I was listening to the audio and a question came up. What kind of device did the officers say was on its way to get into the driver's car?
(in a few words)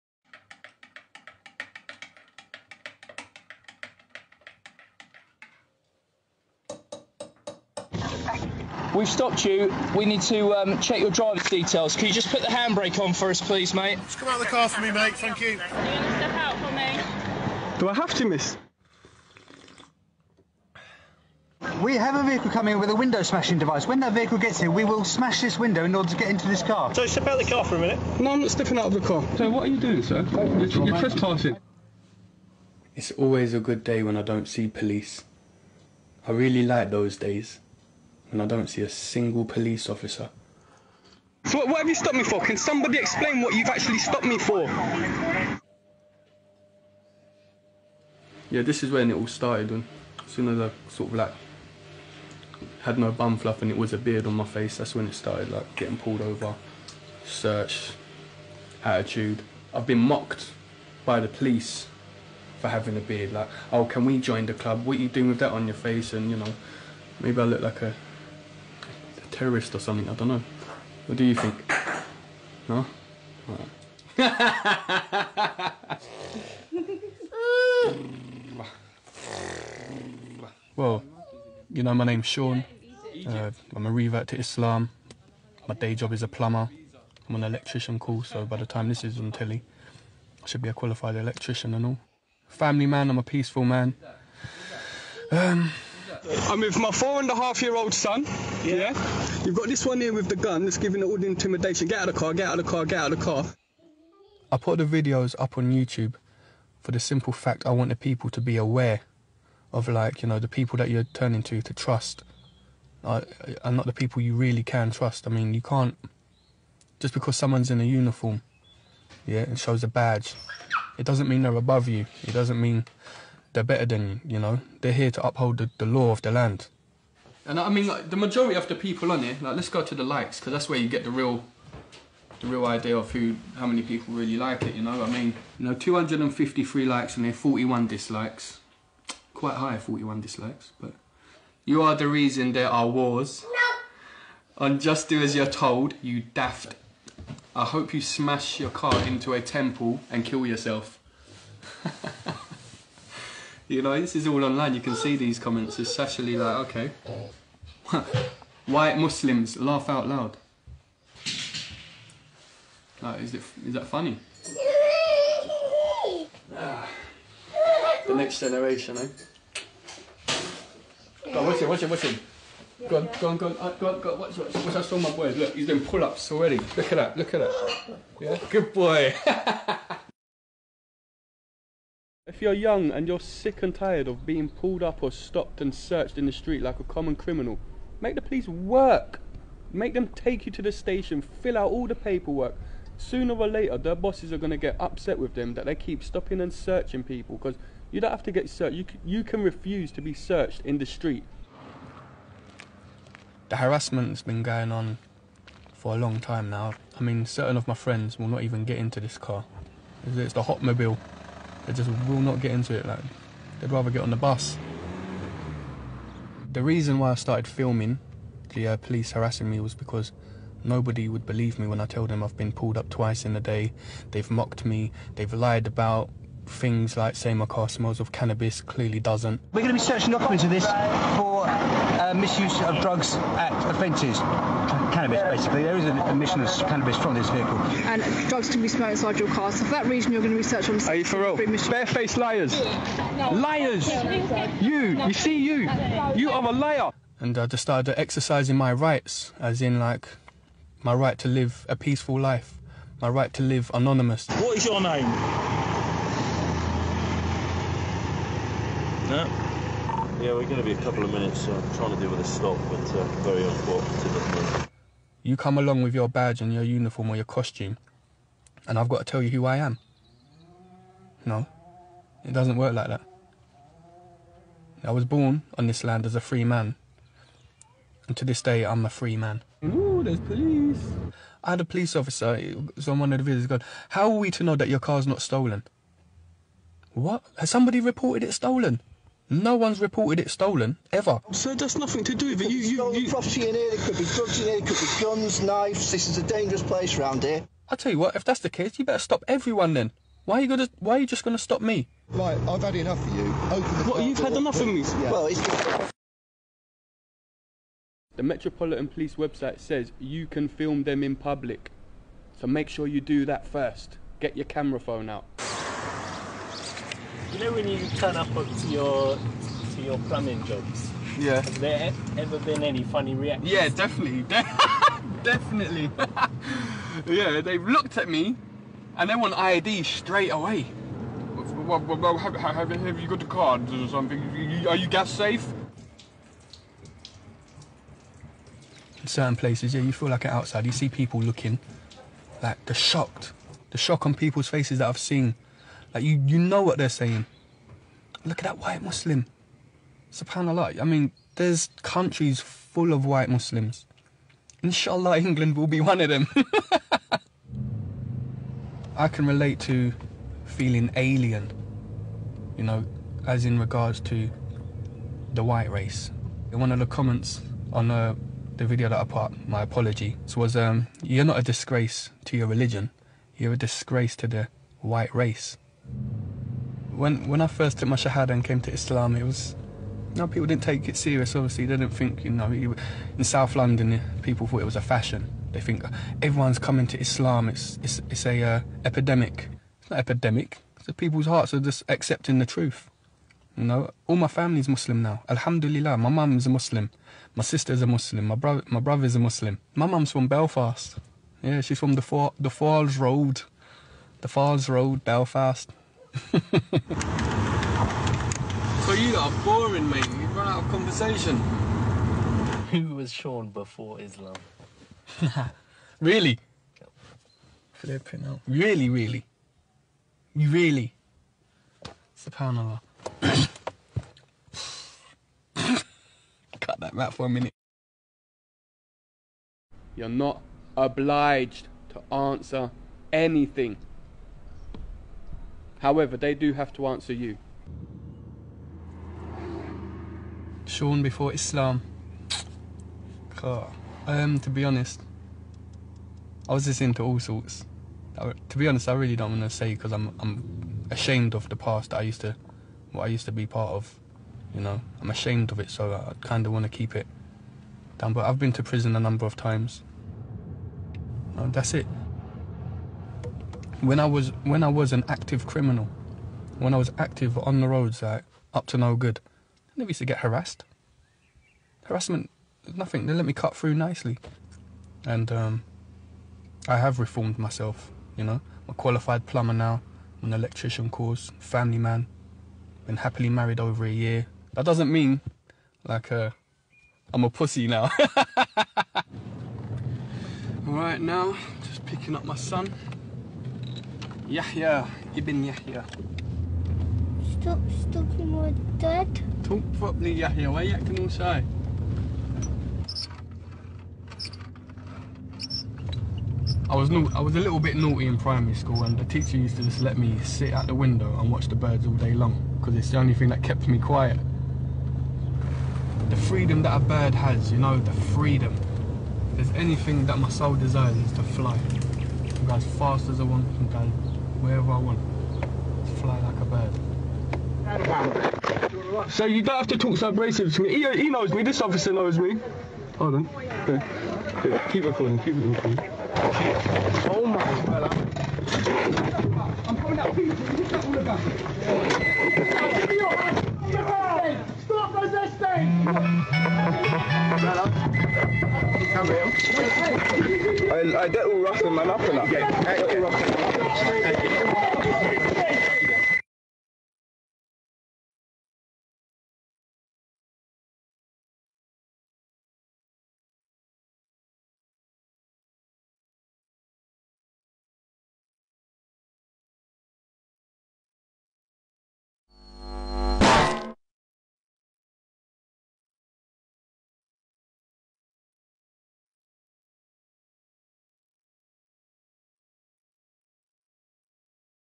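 Window smashing device.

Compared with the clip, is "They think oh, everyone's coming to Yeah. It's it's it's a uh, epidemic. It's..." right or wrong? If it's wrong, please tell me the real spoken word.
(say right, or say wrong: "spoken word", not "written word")
wrong: "Islam", not "Yeah".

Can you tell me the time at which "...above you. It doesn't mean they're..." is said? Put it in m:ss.
2:01.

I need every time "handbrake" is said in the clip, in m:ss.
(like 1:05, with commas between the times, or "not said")
0:12.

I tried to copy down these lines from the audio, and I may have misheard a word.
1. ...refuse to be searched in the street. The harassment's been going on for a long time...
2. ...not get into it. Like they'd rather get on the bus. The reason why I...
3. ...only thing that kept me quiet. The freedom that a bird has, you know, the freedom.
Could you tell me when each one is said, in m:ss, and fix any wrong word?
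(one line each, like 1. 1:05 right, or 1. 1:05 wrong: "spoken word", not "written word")
1. 3:19 right
2. 3:32 right
3. 8:32 right.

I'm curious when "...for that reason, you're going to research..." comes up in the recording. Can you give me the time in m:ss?
3:59.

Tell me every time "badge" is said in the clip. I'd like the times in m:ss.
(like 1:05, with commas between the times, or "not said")
1:59, 4:26.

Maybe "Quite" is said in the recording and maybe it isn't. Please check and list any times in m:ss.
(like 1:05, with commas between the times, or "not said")
2:19.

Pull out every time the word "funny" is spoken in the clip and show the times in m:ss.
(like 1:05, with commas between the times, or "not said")
2:43, 5:22.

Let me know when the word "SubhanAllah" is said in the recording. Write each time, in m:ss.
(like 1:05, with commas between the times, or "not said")
5:50, 7:02.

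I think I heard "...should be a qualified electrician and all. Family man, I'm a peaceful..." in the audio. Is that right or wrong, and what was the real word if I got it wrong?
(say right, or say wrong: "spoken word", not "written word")
right.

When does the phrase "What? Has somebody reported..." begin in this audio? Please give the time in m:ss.
4:46.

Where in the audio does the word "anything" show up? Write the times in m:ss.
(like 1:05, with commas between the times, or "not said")
7:13, 8:39.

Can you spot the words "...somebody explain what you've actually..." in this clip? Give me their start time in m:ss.
0:42.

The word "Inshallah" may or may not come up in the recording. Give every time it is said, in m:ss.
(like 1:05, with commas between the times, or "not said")
5:54.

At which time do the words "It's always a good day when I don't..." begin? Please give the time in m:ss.
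0:32.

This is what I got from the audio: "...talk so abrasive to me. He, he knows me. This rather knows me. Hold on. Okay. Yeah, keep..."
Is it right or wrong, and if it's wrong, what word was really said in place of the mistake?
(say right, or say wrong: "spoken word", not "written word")
wrong: "officer", not "rather".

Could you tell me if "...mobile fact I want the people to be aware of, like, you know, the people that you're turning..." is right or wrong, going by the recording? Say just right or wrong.
wrong.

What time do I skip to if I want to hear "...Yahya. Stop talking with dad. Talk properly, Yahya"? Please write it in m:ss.
8:15.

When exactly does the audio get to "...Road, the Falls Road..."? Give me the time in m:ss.
6:43.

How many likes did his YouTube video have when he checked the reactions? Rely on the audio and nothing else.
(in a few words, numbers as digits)
253.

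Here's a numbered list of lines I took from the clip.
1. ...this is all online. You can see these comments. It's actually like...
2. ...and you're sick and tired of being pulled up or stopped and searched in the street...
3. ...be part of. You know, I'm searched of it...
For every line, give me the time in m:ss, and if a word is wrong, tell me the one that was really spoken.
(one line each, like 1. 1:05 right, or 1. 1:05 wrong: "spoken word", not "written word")
1. 2:33 right
2. 3:02 right
3. 7:33 wrong: "ashamed", not "searched".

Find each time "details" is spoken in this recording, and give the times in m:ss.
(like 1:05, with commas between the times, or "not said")
0:11.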